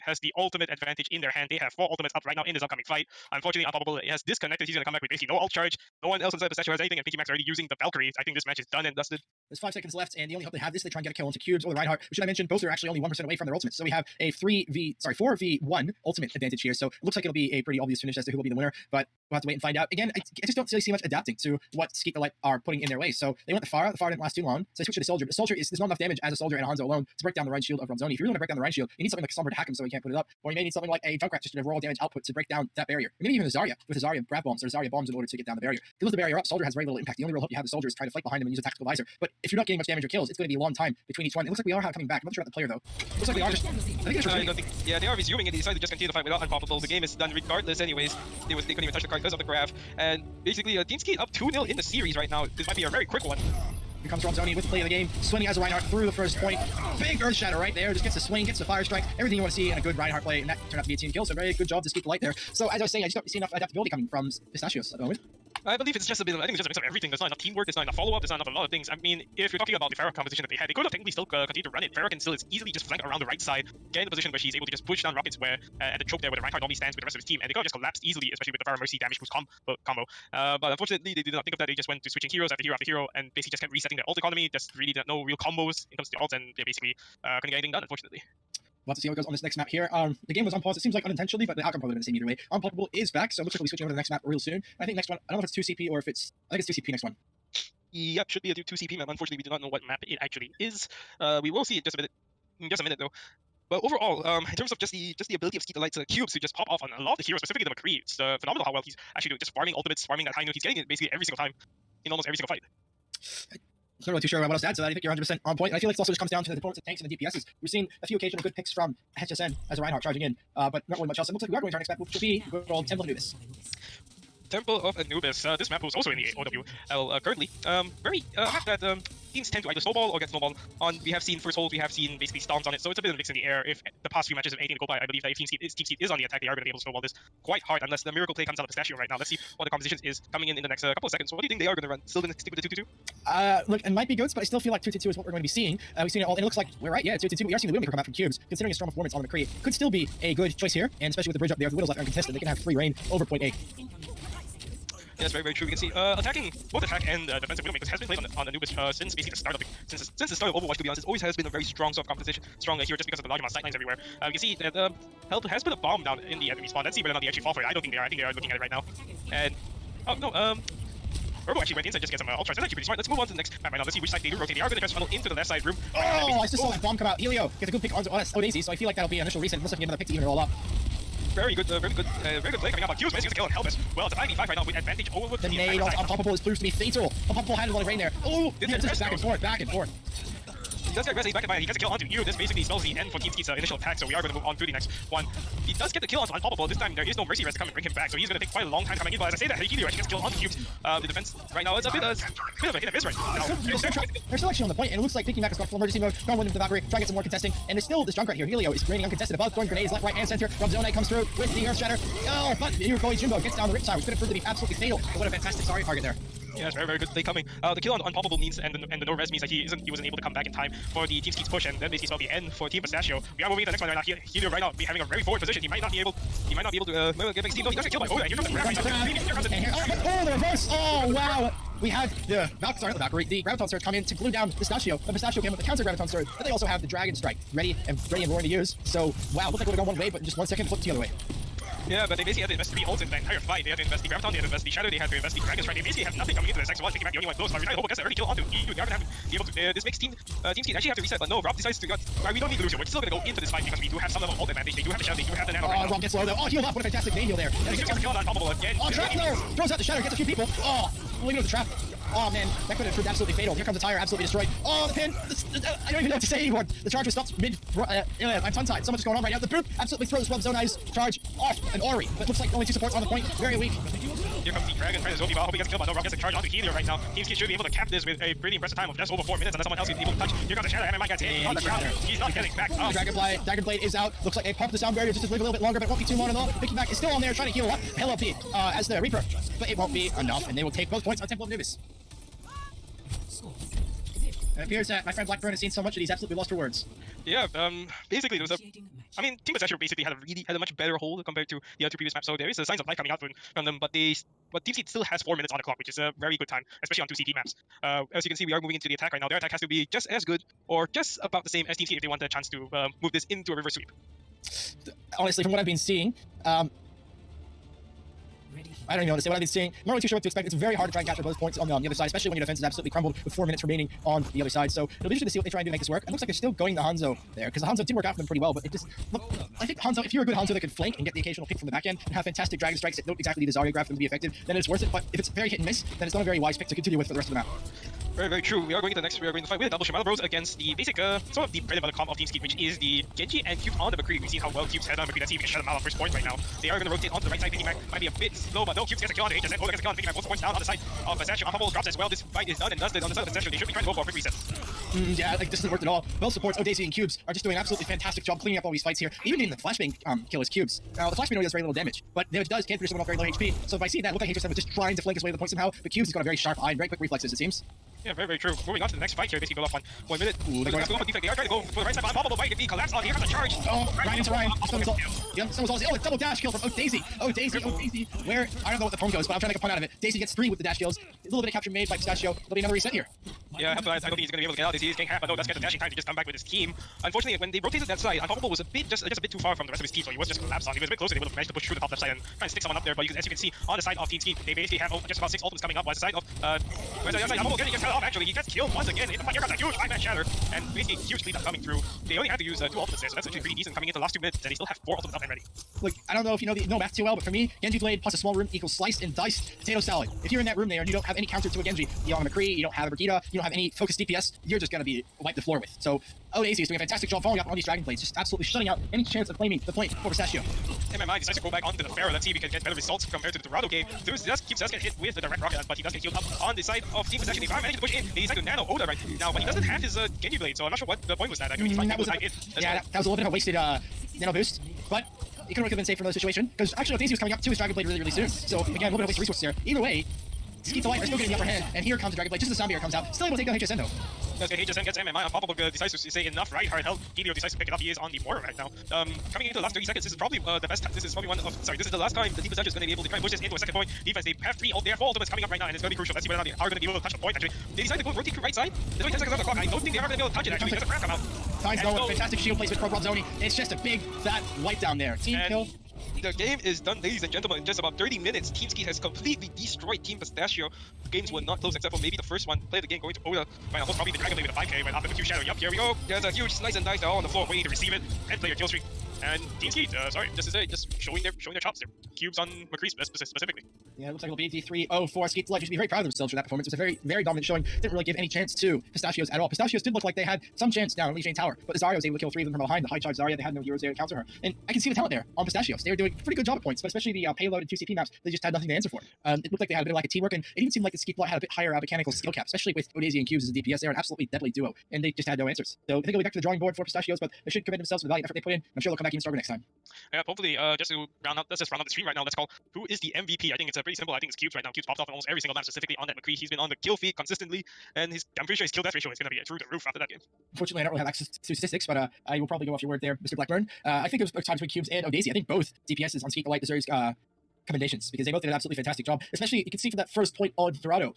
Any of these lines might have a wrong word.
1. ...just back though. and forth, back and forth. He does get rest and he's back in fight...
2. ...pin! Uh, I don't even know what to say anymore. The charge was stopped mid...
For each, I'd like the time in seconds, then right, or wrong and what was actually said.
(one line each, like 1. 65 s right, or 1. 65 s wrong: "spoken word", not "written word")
1. 188 s right
2. 264 s right.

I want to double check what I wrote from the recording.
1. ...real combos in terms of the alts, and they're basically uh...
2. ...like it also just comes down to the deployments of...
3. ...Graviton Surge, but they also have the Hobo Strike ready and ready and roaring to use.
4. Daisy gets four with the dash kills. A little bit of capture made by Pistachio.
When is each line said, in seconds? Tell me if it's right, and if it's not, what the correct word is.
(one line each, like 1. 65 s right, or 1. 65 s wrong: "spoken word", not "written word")
1. 85 s right
2. 115 s right
3. 235 s wrong: "Dragon", not "Hobo"
4. 380 s wrong: "three", not "four".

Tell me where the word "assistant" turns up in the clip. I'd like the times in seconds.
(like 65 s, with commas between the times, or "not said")
not said.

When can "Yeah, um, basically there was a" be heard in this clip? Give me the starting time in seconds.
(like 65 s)
297 s.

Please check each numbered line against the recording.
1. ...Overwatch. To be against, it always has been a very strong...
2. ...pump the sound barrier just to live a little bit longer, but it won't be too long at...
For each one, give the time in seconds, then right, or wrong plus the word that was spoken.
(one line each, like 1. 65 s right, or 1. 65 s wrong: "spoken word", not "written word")
1. 160 s wrong: "honest", not "against"
2. 284 s right.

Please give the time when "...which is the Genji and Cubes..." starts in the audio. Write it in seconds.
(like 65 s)
342 s.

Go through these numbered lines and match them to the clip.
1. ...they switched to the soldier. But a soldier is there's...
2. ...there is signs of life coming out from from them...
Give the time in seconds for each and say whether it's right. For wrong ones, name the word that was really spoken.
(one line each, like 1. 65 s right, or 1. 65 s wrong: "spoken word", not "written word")
1. 24 s right
2. 302 s right.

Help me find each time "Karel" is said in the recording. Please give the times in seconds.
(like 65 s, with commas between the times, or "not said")
not said.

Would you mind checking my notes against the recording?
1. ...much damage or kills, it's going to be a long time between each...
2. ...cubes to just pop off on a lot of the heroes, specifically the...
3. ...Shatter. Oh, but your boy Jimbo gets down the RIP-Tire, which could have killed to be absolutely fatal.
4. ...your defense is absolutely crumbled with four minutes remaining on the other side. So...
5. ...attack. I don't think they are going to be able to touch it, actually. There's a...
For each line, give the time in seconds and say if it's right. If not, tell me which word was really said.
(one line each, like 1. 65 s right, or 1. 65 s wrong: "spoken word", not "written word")
1. 39 s right
2. 106 s right
3. 211 s wrong: "proved", not "killed"
4. 322 s right
5. 459 s wrong: "clock", not "attack".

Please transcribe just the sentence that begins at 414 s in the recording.
You're just gonna be wiped the floor with.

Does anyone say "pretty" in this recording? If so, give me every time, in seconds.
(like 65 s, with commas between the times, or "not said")
17 s, 172 s, 278 s, 328 s, 403 s, 496 s, 513 s, 518 s.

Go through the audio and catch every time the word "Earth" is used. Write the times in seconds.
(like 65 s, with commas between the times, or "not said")
57 s, 211 s.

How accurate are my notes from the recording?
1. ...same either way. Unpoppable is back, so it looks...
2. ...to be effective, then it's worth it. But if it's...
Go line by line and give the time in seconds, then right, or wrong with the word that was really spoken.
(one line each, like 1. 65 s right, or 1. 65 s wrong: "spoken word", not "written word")
1. 92 s right
2. 333 s right.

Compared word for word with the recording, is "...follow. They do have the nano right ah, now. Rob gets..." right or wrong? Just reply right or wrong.
wrong.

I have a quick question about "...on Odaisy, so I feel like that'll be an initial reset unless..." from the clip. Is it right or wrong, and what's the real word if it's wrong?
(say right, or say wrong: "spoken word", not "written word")
right.